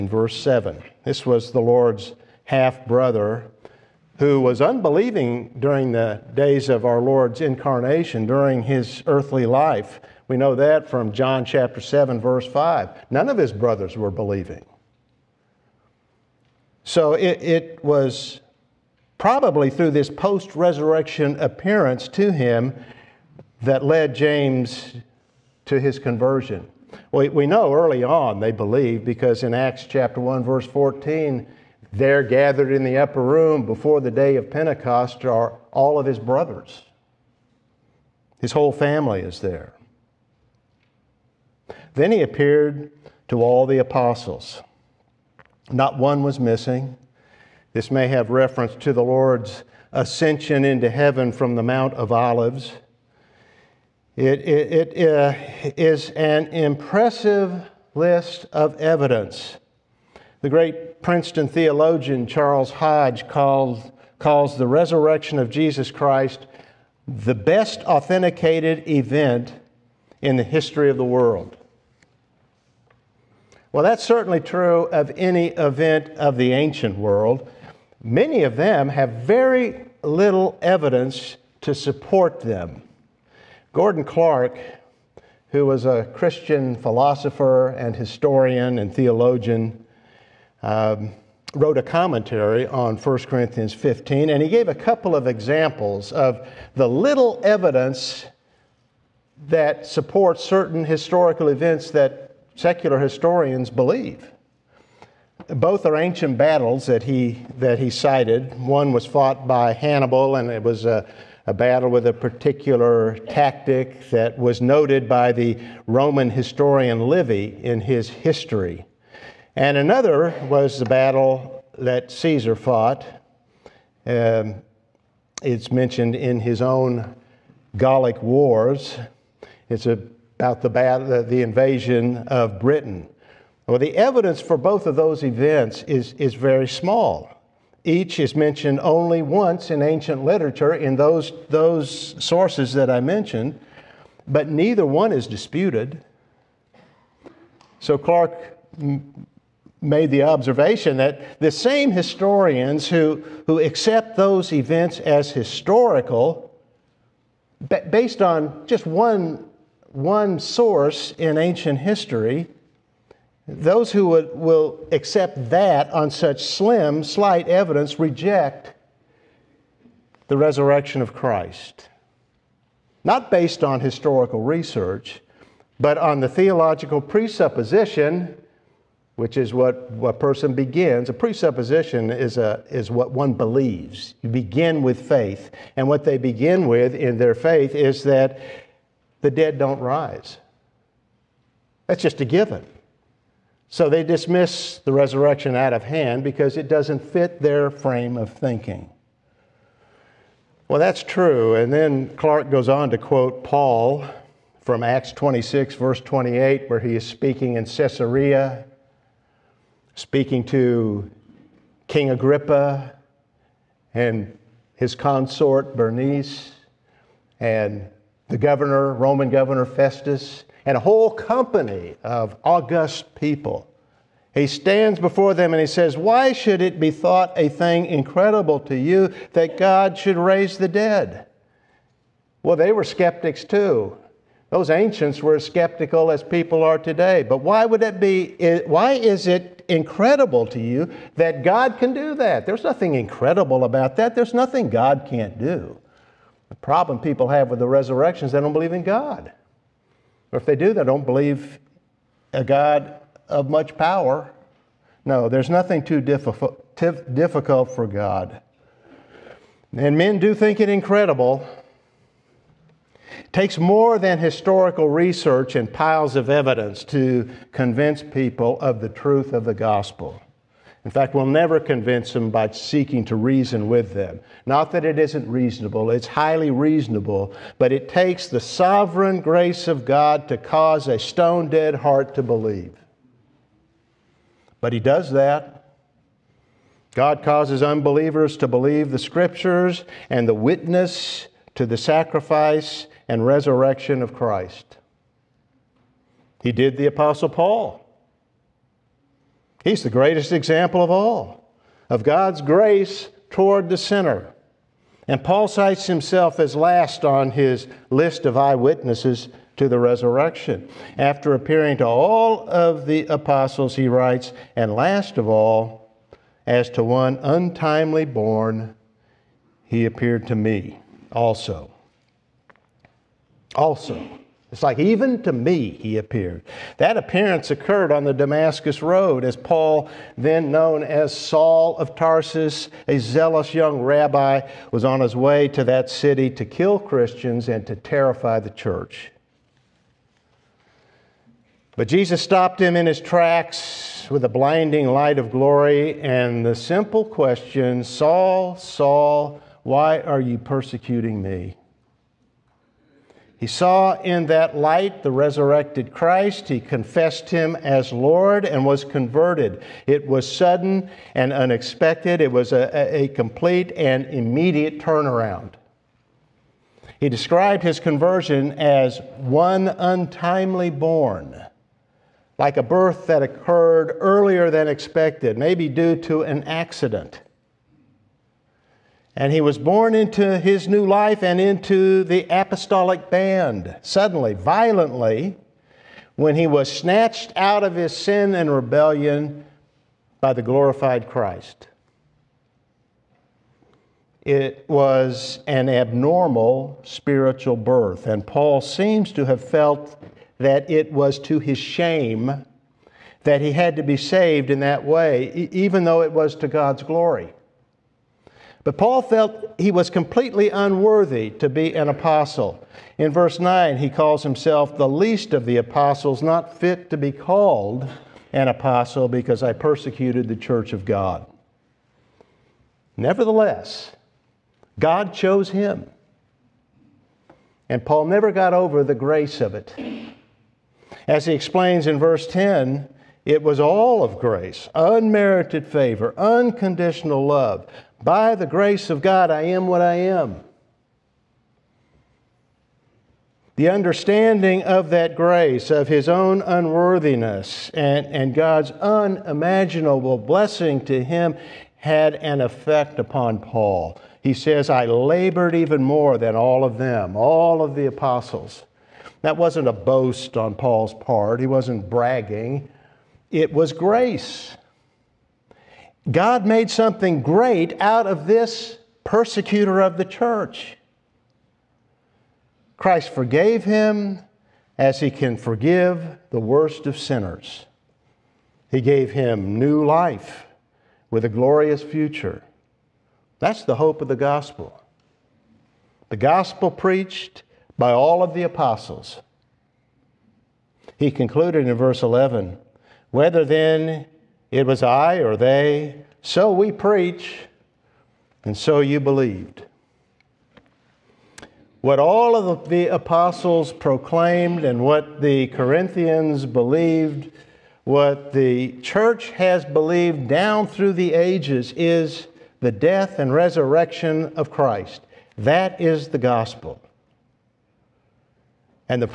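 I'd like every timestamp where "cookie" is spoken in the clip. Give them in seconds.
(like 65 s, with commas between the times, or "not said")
not said.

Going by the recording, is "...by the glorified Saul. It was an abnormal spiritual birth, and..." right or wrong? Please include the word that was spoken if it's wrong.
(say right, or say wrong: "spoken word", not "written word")
wrong: "Christ", not "Saul".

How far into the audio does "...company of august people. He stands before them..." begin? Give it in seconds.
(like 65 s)
221 s.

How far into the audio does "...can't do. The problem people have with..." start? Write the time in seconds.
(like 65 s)
245 s.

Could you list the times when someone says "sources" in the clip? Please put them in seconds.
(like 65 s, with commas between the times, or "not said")
142 s, 160 s.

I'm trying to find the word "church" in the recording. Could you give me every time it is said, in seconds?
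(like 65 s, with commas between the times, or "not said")
338 s, 420 s, 470 s, 508 s.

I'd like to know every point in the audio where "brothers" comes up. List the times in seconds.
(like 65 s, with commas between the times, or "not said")
2 s, 13 s, 36 s.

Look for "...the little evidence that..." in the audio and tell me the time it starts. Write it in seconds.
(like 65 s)
96 s.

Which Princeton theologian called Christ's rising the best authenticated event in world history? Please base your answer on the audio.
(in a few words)
Charles Hodge.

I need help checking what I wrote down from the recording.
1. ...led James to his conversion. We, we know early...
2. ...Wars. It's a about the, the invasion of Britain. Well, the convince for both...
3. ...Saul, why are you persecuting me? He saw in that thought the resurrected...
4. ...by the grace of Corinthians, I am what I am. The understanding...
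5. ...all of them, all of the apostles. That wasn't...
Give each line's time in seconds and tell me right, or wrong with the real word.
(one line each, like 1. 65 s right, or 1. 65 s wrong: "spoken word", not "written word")
1. 23 s right
2. 128 s wrong: "evidence", not "convince"
3. 348 s wrong: "light", not "thought"
4. 438 s wrong: "God", not "Corinthians"
5. 456 s right.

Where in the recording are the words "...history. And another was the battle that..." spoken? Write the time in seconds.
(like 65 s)
118 s.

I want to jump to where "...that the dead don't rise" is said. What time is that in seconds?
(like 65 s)
188 s.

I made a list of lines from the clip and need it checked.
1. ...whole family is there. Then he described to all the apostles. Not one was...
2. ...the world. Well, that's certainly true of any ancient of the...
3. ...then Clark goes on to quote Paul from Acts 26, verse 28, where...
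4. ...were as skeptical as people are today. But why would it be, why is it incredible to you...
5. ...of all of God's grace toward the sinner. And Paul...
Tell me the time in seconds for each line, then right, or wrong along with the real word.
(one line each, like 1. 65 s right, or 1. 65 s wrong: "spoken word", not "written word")
1. 38 s wrong: "appeared", not "described"
2. 70 s wrong: "event", not "ancient"
3. 201 s right
4. 235 s right
5. 300 s right.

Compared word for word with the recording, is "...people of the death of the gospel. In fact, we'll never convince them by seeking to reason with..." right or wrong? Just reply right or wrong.
wrong.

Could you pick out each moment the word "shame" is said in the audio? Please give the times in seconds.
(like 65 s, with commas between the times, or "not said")
401 s.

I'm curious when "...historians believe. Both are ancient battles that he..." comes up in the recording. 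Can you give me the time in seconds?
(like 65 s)
102 s.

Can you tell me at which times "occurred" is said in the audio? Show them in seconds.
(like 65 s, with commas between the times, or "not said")
327 s, 373 s.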